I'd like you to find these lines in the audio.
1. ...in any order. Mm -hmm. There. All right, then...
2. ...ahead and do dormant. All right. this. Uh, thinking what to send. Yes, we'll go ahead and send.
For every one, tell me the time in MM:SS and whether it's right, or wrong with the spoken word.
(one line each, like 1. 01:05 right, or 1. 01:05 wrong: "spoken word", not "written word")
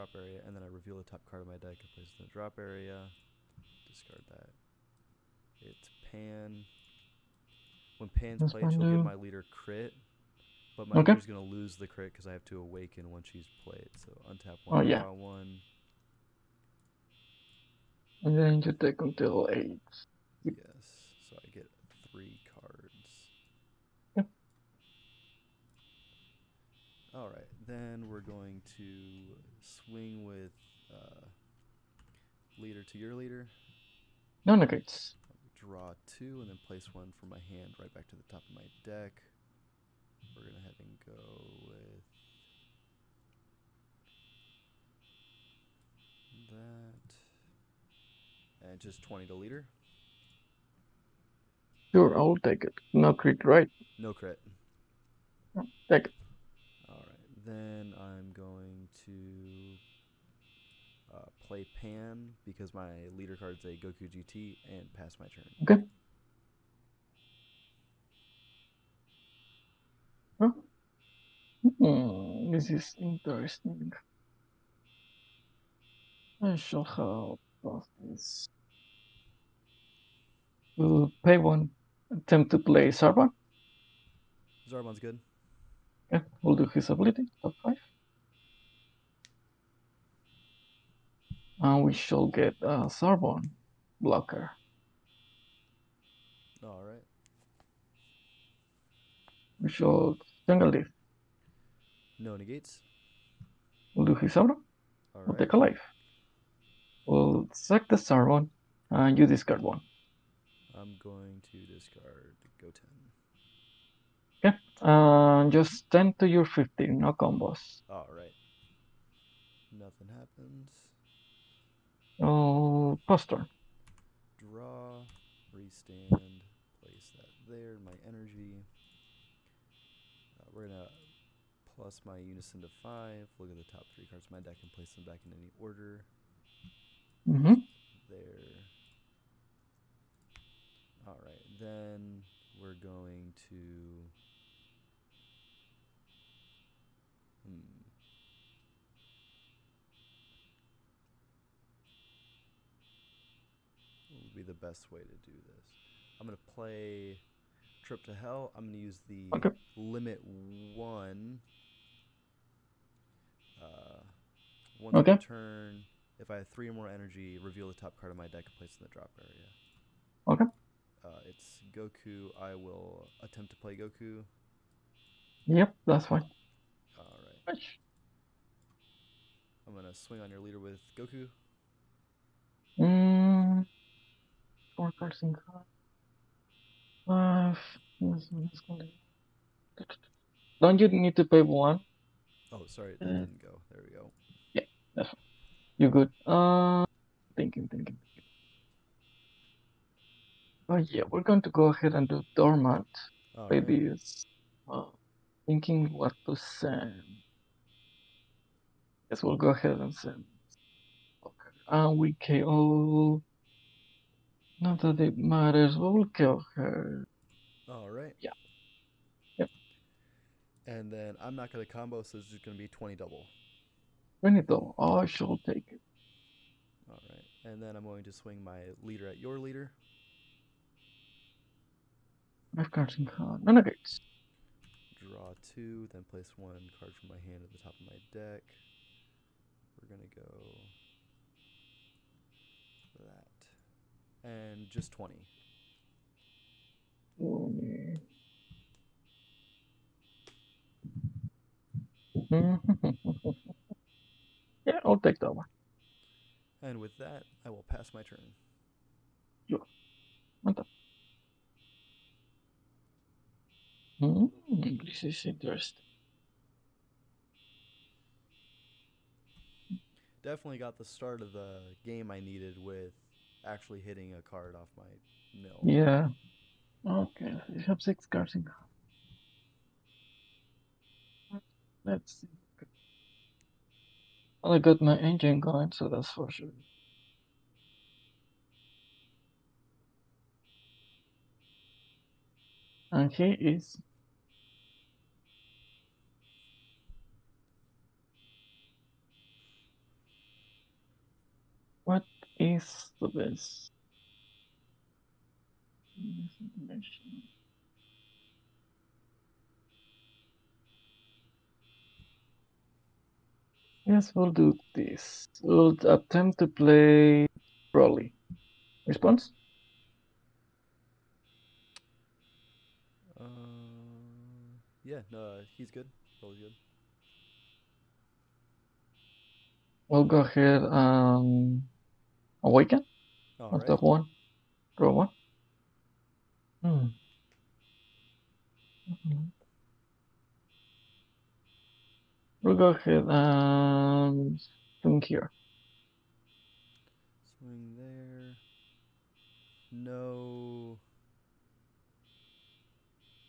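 1. 02:15 right
2. 03:21 right.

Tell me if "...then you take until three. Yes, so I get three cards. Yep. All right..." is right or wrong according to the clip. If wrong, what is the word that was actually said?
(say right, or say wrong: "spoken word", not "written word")
wrong: "eight", not "three".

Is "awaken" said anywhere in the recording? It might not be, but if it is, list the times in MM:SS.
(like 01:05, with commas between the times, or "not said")
00:12, 05:32.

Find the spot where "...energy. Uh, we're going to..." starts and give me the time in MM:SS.
02:08.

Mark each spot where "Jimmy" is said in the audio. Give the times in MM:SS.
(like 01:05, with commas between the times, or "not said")
not said.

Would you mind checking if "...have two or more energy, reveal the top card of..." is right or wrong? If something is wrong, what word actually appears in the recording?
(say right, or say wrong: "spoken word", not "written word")
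wrong: "three", not "two".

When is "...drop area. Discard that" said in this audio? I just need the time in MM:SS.
00:02.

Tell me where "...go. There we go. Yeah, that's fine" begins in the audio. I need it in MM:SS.
03:13.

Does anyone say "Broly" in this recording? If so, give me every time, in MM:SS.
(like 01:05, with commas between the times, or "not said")
05:17, 05:26.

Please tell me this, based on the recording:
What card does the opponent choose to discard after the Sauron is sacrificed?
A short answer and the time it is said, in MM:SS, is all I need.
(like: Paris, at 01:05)
Go 10, at 01:52.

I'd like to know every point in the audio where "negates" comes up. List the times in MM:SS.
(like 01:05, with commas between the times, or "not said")
00:34, 01:42.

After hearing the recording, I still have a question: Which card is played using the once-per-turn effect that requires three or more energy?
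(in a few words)
Trip to Hell.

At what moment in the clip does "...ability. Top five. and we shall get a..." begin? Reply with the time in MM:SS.
01:26.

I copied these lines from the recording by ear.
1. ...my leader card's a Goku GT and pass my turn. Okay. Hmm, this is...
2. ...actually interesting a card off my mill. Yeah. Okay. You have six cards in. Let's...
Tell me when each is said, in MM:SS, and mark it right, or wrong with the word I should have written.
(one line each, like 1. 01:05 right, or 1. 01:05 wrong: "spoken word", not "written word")
1. 01:02 right
2. 04:33 wrong: "hitting", not "interesting".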